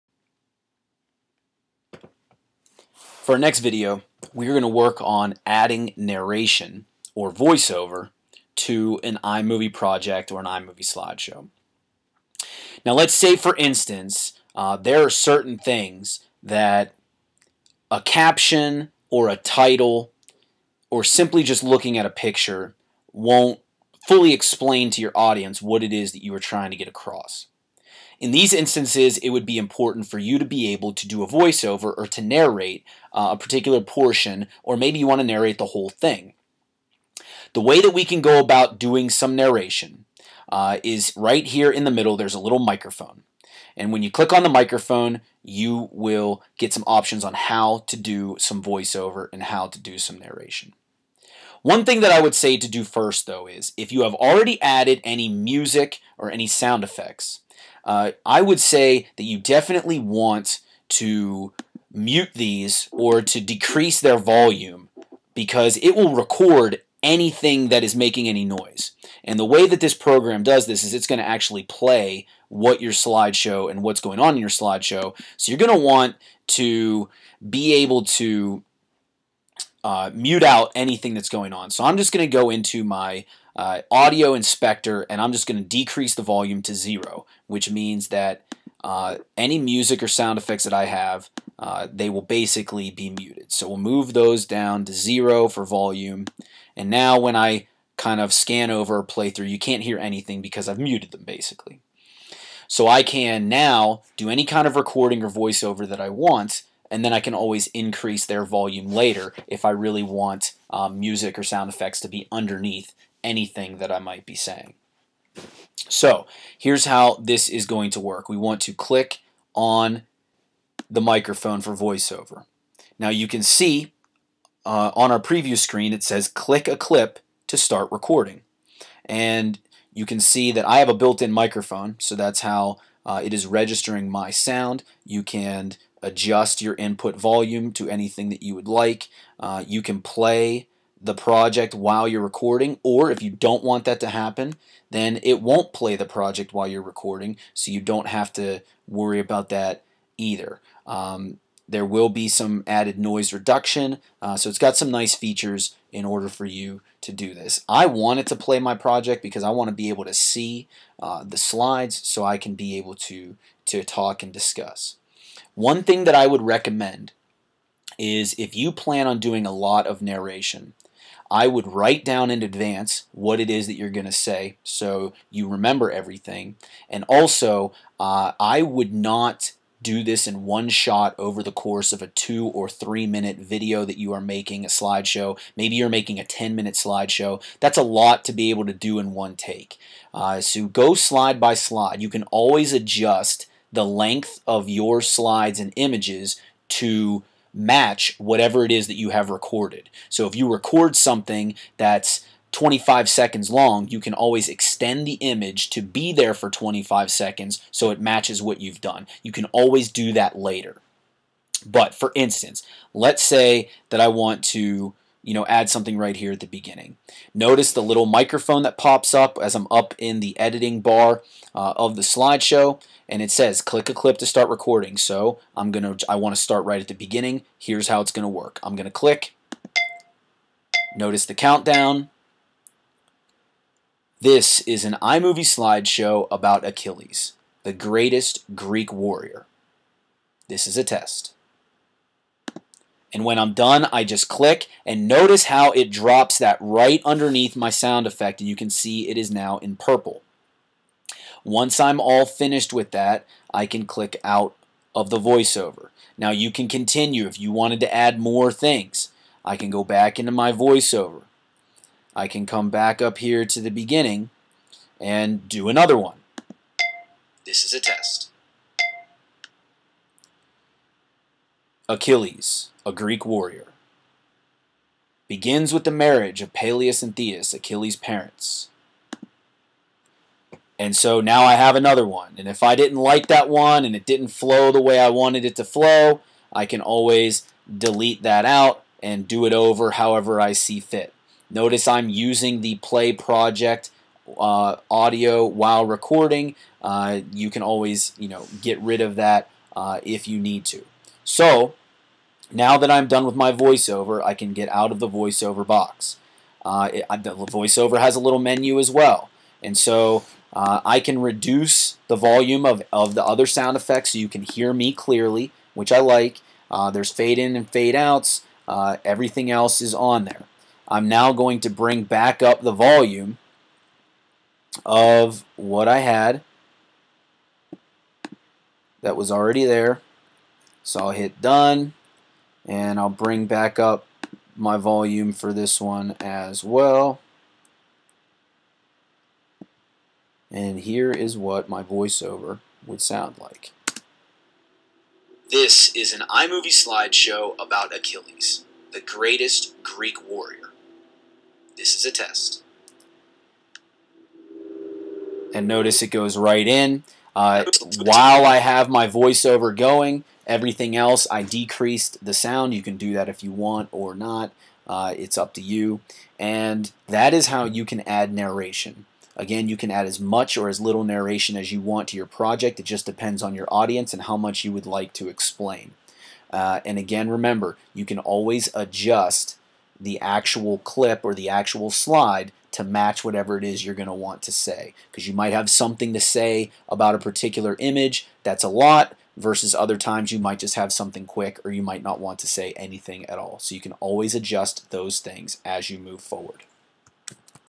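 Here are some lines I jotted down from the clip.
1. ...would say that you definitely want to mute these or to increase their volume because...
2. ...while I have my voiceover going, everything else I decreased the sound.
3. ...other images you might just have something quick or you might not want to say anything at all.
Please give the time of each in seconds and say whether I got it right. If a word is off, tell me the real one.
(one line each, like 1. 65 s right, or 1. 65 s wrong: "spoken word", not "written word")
1. 58 s wrong: "decrease", not "increase"
2. 357 s right
3. 389 s wrong: "times", not "images".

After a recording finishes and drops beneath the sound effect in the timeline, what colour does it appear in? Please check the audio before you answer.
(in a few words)
purple.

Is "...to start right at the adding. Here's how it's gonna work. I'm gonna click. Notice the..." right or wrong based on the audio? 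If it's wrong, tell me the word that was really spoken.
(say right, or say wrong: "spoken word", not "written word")
wrong: "beginning", not "adding".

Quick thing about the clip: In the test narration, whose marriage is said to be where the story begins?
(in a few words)
Peleus and Thetis.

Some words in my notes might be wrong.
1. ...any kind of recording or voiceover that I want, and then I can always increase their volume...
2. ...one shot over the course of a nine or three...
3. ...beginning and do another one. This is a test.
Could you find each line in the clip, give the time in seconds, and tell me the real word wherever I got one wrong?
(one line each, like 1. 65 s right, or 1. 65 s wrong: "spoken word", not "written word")
1. 104 s right
2. 180 s wrong: "two", not "nine"
3. 263 s right.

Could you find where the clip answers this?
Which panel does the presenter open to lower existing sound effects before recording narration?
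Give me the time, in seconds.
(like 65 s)
83 s.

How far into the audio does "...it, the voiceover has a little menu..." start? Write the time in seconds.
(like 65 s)
306 s.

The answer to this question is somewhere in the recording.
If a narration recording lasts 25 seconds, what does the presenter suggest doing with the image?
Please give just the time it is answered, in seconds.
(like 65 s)
204 s.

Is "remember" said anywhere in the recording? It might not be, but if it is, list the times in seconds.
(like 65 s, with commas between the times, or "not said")
175 s, 377 s.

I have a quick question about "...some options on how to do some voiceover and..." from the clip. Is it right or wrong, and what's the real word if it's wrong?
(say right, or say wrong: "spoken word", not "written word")
right.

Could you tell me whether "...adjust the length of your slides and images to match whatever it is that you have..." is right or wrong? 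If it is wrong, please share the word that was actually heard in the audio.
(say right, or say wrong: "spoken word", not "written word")
right.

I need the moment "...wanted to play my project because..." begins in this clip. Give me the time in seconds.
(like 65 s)
157 s.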